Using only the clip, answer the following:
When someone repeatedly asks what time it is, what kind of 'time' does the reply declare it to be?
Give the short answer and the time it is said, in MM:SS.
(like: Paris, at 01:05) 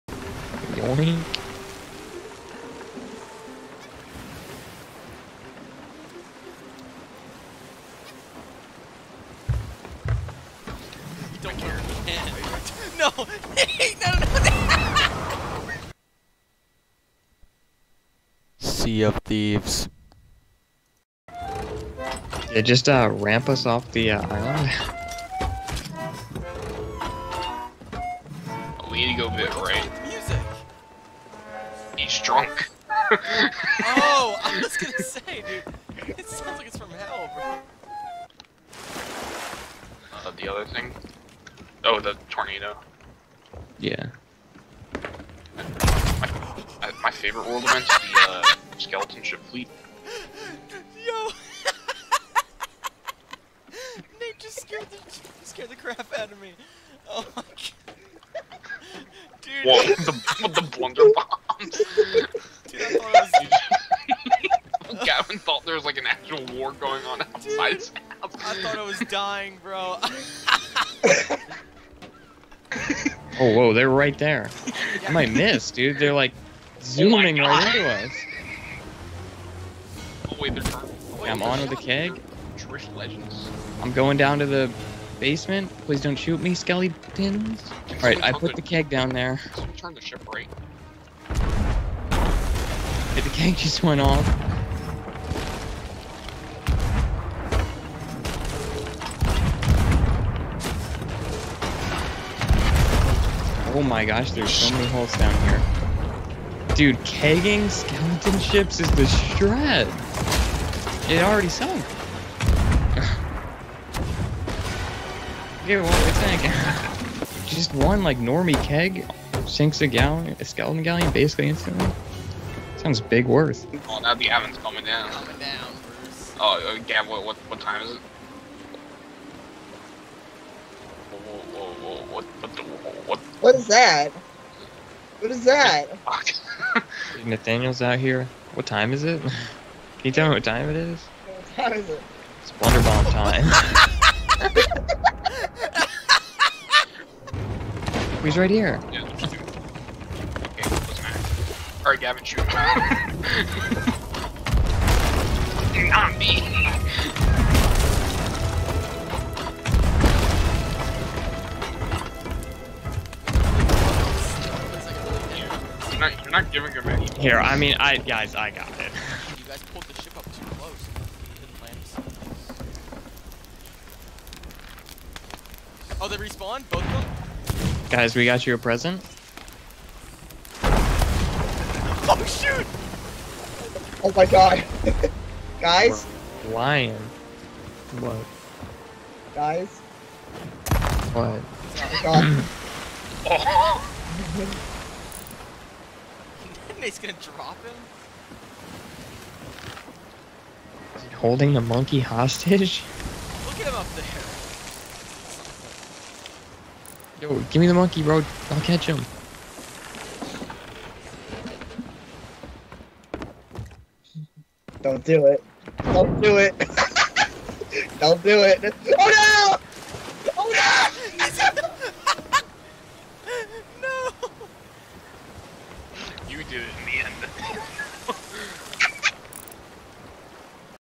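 Blunderbomb time, at 02:22.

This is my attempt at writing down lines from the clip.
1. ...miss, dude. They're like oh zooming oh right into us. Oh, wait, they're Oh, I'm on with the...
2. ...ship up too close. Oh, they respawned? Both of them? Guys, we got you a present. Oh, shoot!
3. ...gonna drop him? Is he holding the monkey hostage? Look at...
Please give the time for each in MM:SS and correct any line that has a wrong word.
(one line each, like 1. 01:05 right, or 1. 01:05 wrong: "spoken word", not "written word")
1. 01:15 right
2. 02:50 right
3. 03:16 right.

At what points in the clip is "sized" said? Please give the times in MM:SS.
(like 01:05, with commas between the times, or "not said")
not said.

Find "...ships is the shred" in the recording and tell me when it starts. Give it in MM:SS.
01:48.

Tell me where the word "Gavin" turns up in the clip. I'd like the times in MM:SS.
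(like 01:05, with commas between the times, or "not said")
01:05, 02:31.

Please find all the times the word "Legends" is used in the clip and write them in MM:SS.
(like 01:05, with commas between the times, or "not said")
01:22.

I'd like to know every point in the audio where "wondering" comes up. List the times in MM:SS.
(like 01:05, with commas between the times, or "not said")
not said.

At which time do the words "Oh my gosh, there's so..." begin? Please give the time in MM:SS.
01:43.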